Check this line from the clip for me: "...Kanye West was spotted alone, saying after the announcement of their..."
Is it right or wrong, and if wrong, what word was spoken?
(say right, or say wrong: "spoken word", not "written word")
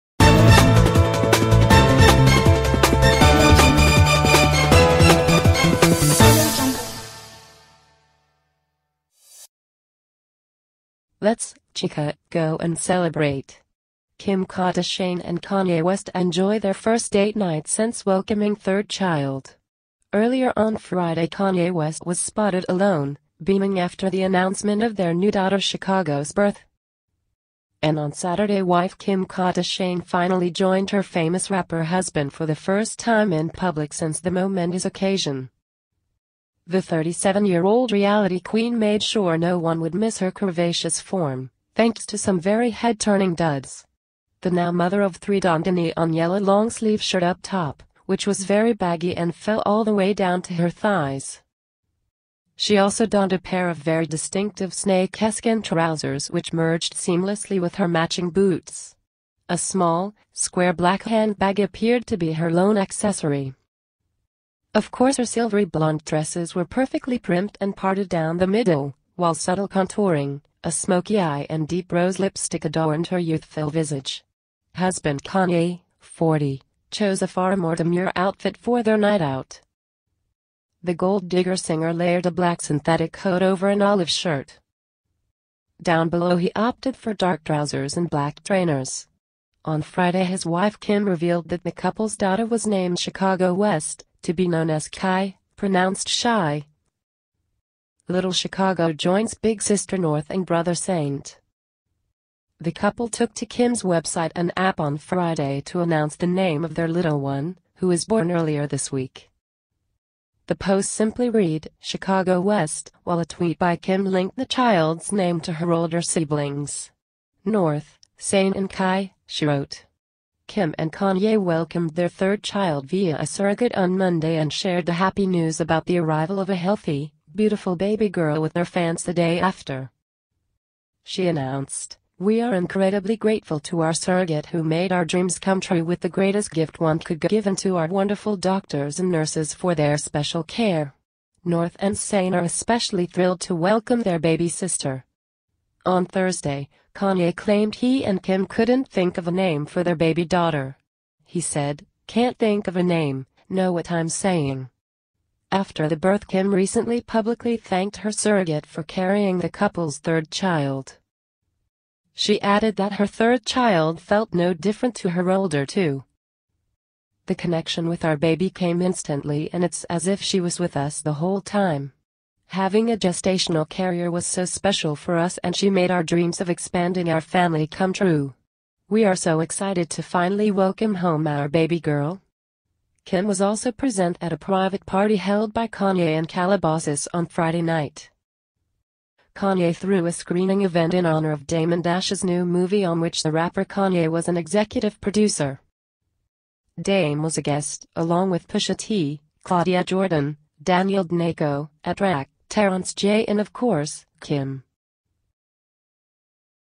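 wrong: "beaming", not "saying".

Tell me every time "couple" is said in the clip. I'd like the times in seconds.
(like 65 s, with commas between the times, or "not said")
91 s, 102 s, 159 s.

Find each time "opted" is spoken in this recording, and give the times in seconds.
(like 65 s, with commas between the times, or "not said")
86 s.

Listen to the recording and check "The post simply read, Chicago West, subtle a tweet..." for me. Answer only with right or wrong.
wrong.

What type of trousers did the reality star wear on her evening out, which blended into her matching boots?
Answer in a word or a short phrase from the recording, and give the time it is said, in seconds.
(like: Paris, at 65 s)
snake skin trousers, at 54 s.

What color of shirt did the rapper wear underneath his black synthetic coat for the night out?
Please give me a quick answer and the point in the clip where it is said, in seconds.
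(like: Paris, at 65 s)
olive, at 83 s.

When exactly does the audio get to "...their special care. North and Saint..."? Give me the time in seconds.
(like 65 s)
139 s.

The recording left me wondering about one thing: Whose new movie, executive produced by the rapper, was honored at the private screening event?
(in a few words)
Damon Dash.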